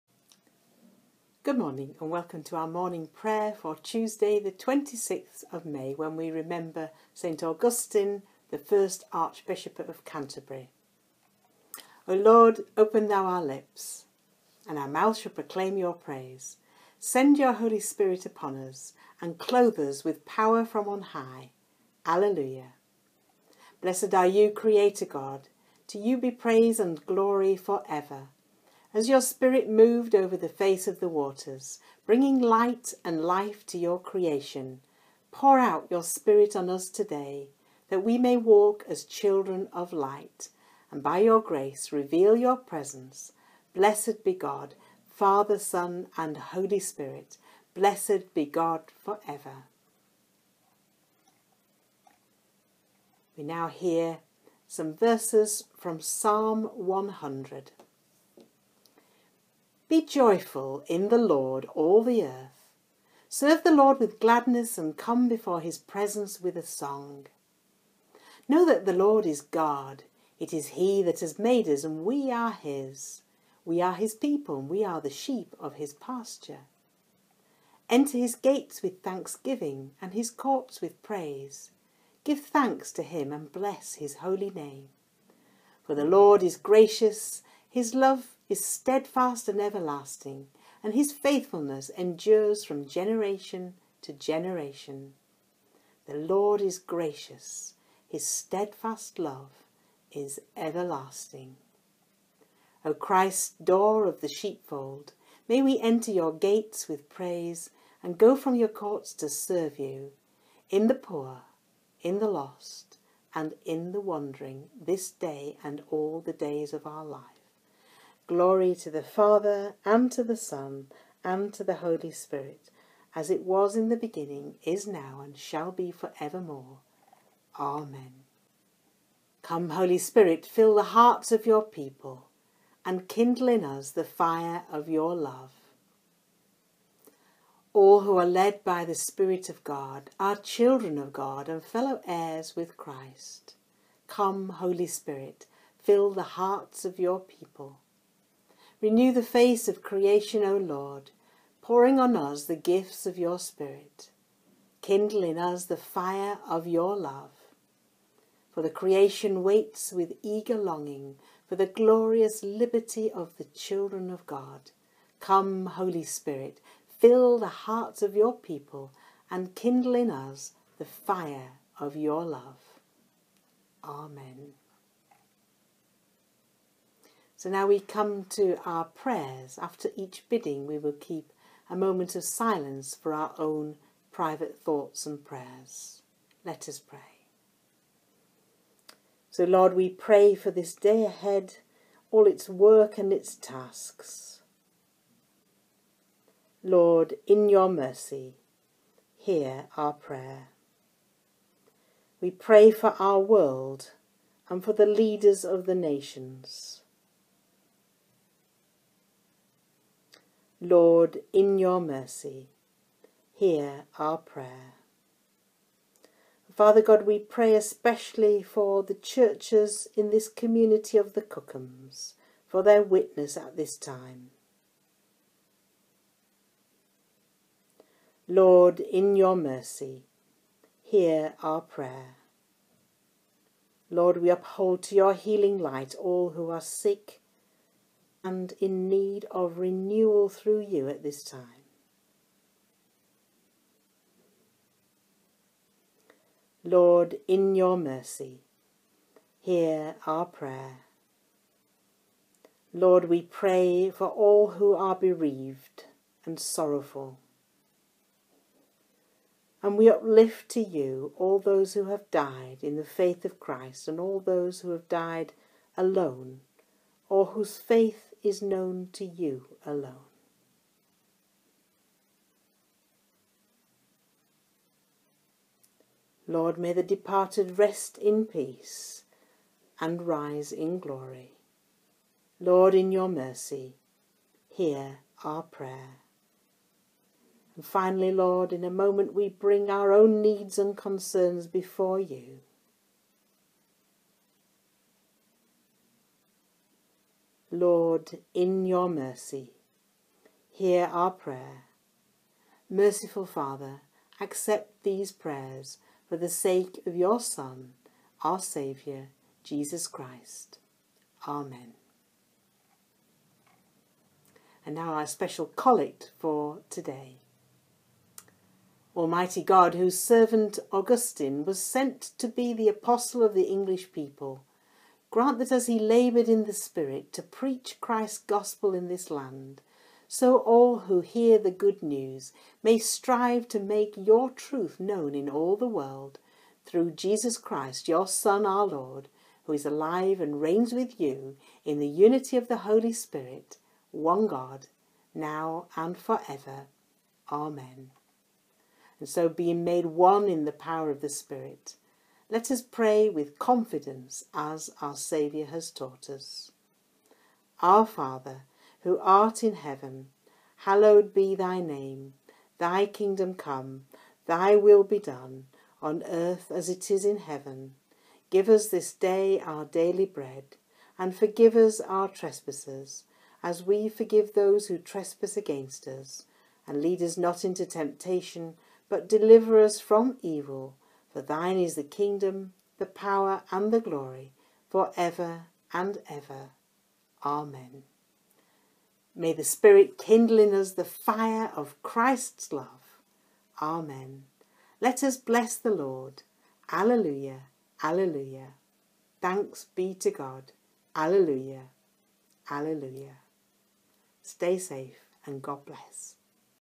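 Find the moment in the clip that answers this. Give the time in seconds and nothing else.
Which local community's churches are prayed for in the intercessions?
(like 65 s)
221 s.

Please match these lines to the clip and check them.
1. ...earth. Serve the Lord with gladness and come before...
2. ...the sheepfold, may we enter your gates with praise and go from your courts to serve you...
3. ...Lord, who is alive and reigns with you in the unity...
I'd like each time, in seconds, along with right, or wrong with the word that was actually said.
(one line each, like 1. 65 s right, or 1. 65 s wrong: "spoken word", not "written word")
1. 62 s right
2. 104 s right
3. 338 s right.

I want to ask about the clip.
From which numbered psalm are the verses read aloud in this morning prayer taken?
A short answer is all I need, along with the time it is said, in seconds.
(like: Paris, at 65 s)
100, at 56 s.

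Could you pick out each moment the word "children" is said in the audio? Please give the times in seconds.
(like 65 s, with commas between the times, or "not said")
39 s, 140 s, 163 s.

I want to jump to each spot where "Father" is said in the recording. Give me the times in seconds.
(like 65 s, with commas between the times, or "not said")
45 s, 119 s, 216 s, 303 s, 357 s.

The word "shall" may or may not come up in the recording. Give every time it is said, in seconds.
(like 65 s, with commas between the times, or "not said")
15 s, 125 s.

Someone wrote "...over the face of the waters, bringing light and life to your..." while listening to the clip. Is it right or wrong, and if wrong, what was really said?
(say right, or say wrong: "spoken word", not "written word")
right.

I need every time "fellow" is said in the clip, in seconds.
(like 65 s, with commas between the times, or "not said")
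141 s.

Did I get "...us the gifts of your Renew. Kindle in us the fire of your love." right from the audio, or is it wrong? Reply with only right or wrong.
wrong.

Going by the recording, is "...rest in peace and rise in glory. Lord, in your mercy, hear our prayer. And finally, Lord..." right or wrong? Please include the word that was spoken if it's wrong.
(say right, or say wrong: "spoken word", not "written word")
right.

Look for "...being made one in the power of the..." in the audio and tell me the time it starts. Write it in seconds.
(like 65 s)
349 s.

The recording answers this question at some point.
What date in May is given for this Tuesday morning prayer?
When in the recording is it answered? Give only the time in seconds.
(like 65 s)
4 s.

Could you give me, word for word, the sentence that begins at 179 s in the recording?
After each bidding, we will keep a moment of silence for our own private thoughts and prayers.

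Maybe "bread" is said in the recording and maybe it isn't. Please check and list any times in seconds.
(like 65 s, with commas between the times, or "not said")
370 s.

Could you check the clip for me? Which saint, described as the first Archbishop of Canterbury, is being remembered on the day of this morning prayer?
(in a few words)
St Augustine.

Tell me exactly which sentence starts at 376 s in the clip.
And lead us not into temptation, but deliver us from evil.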